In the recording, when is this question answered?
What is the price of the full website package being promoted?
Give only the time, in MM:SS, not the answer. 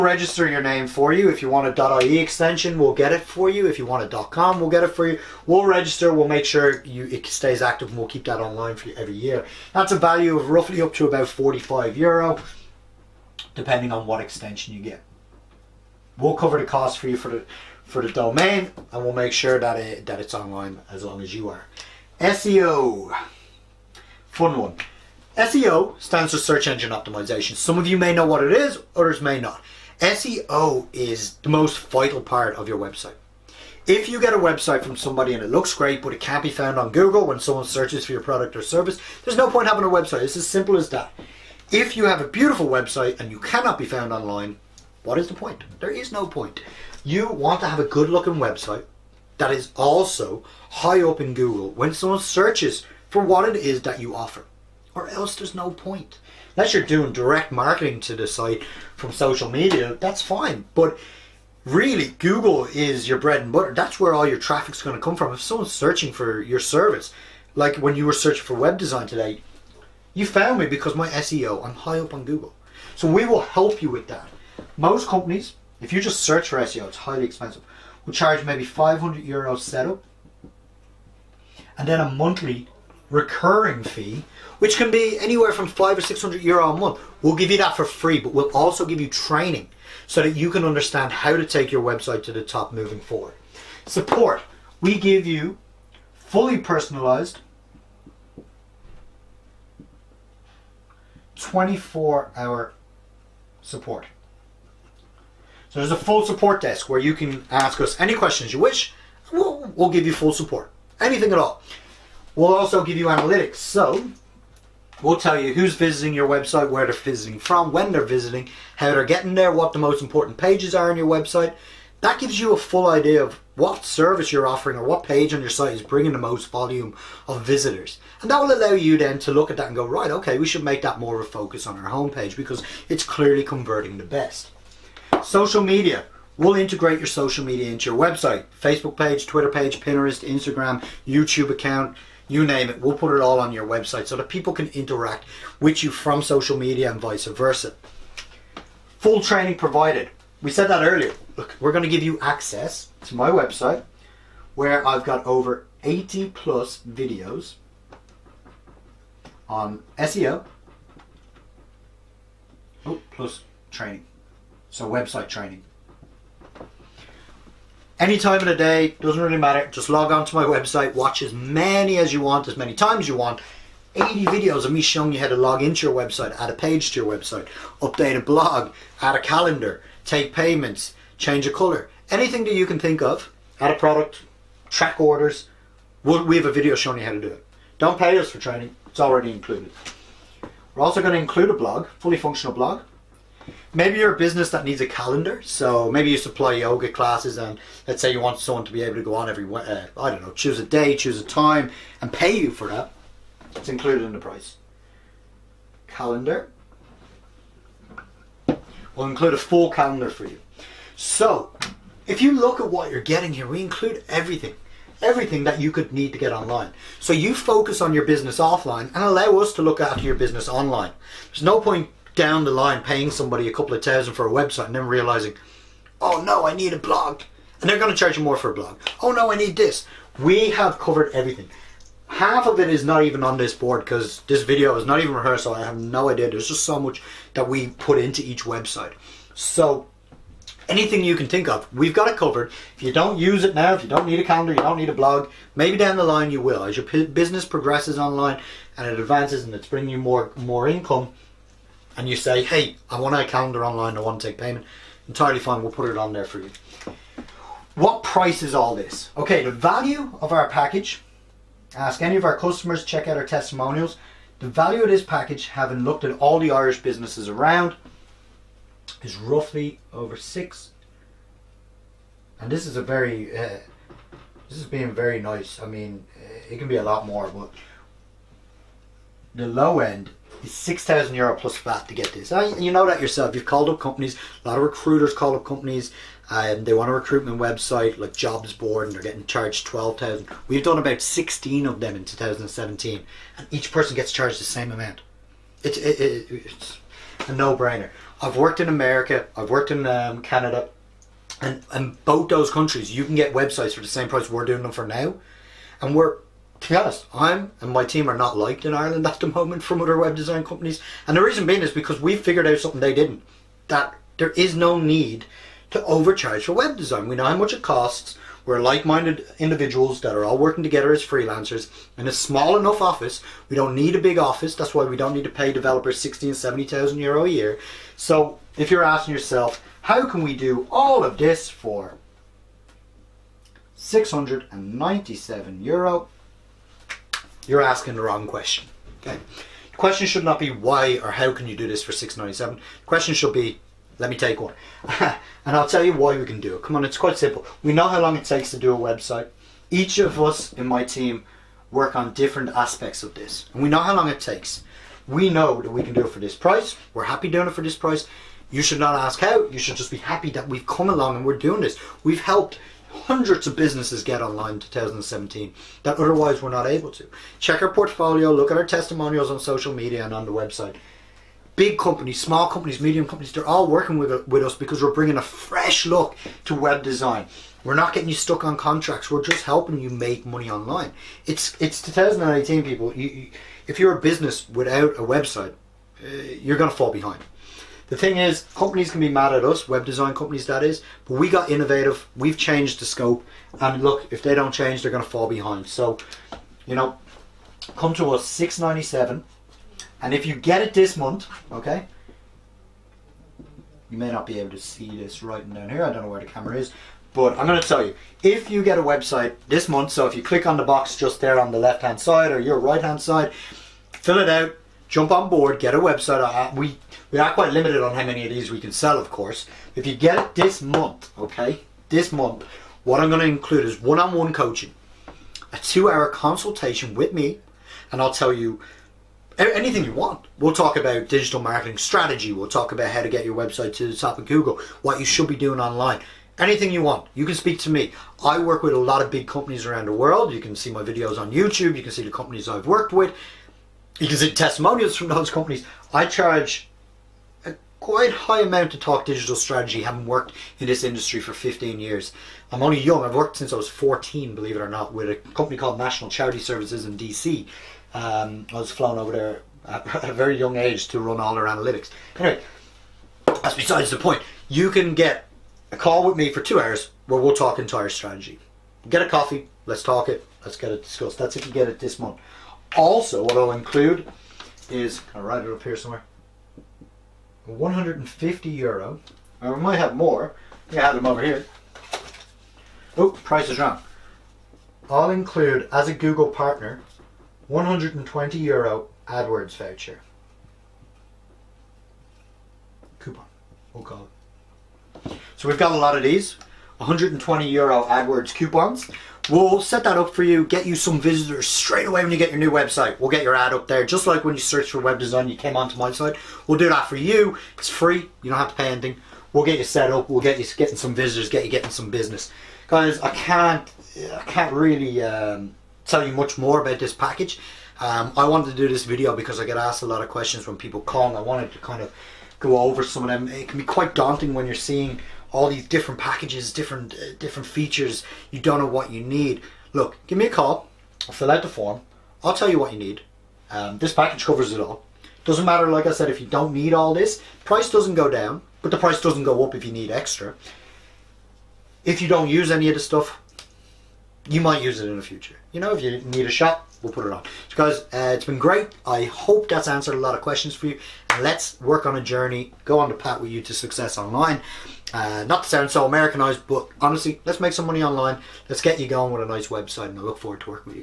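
05:33.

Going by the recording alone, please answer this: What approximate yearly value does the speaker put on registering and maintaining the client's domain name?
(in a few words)
45 euro.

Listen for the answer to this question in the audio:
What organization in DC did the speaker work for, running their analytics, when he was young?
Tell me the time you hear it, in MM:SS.
07:35.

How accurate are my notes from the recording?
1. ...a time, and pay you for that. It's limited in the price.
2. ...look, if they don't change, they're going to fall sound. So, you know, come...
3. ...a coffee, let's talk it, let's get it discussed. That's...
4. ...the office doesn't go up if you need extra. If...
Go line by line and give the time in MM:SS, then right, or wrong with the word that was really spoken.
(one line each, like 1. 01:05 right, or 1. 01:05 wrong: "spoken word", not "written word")
1. 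03:21 wrong: "included", not "limited"
2. 06:33 wrong: "behind", not "sound"
3. 07:49 right
4. 08:58 wrong: "price", not "office".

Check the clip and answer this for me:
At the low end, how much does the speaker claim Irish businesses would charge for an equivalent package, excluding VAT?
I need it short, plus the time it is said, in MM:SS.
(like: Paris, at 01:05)
6,000 euro, at 04:40.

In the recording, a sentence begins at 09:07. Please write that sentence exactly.
So guys, uh, it's been great.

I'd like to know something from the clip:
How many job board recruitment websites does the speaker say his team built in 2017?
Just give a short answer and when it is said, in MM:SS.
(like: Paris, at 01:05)
16, at 04:50.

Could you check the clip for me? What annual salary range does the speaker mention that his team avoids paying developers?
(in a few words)
60 and 70,000 euro.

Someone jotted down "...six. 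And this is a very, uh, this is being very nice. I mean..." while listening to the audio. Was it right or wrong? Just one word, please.
right.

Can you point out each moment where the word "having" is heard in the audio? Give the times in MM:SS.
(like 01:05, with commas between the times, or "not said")
00:39, 04:25, 07:29.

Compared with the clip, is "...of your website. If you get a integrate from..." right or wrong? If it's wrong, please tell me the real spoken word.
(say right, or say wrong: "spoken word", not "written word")
wrong: "website", not "integrate".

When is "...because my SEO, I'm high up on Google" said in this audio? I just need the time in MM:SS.
01:10.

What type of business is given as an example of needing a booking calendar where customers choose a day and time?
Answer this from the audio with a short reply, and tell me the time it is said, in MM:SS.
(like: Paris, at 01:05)
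yoga classes, at 03:16.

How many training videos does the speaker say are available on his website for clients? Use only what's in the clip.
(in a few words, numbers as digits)
80.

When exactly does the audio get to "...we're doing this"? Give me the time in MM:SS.
06:01.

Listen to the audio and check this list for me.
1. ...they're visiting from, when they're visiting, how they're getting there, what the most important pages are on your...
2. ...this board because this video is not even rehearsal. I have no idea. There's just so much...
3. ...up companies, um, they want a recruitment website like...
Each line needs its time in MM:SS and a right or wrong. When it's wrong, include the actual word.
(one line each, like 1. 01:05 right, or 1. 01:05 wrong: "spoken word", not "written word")
1. 01:56 right
2. 03:53 right
3. 04:45 right.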